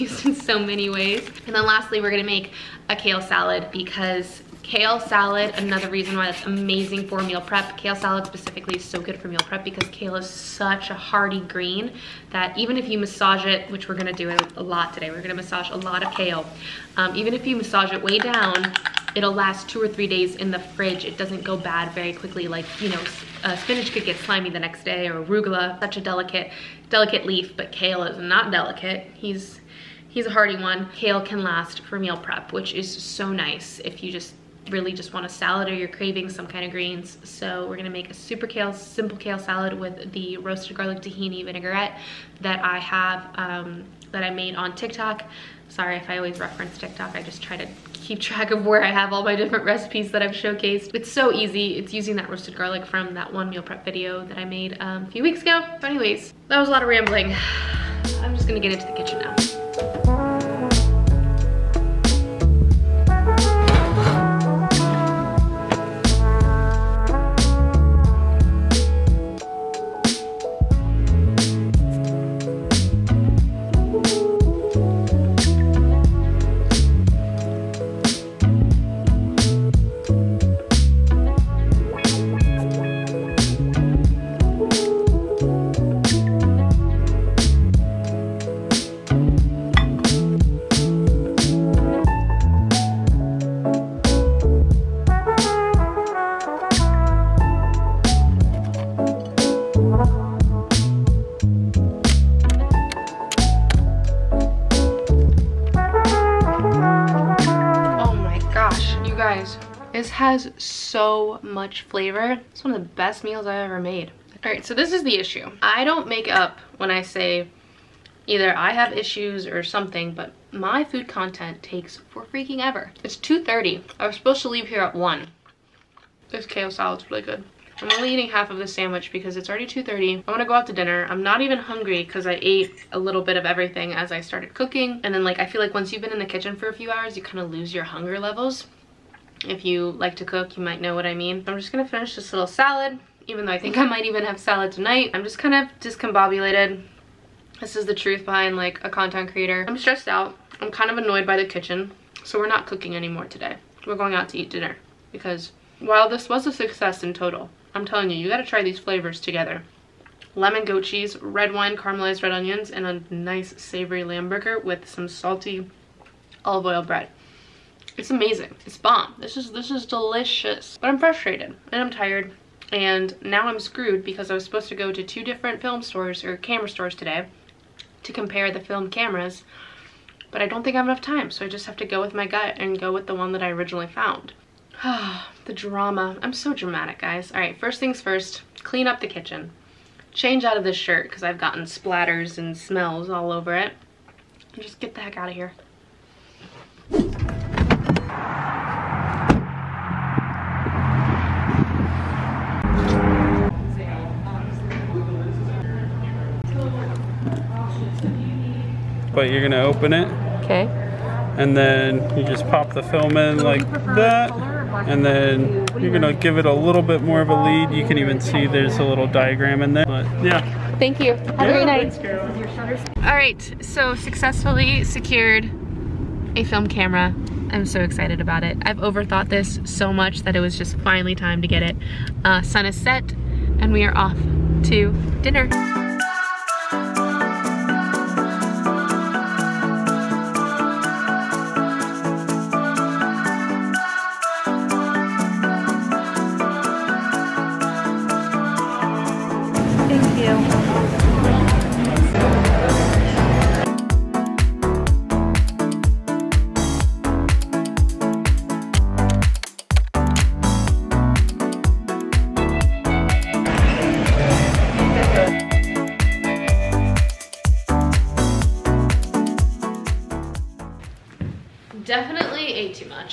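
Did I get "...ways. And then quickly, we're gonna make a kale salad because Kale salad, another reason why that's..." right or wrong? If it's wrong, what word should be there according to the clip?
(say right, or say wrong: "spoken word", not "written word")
wrong: "lastly", not "quickly".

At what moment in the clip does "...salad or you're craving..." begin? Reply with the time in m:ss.
0:35.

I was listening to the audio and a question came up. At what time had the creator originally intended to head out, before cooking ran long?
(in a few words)
1.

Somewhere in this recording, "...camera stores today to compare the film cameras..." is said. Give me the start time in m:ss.
2:56.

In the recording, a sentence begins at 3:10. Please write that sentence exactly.
Change out of this shirt because I've gotten splatters and smells all over it.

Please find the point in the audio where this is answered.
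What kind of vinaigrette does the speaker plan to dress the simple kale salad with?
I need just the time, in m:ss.
0:40.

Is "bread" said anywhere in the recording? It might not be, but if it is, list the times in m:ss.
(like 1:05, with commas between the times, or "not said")
2:46.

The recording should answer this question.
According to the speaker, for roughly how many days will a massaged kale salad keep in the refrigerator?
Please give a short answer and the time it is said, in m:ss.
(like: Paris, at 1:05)
2 or 3 days, at 0:19.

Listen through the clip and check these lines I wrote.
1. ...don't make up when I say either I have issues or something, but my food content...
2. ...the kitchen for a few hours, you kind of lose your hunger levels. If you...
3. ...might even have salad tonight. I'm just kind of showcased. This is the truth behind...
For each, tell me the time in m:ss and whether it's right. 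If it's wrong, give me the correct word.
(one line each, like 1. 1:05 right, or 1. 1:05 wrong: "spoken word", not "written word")
1. 1:55 right
2. 2:16 right
3. 2:23 wrong: "discombobulated", not "showcased".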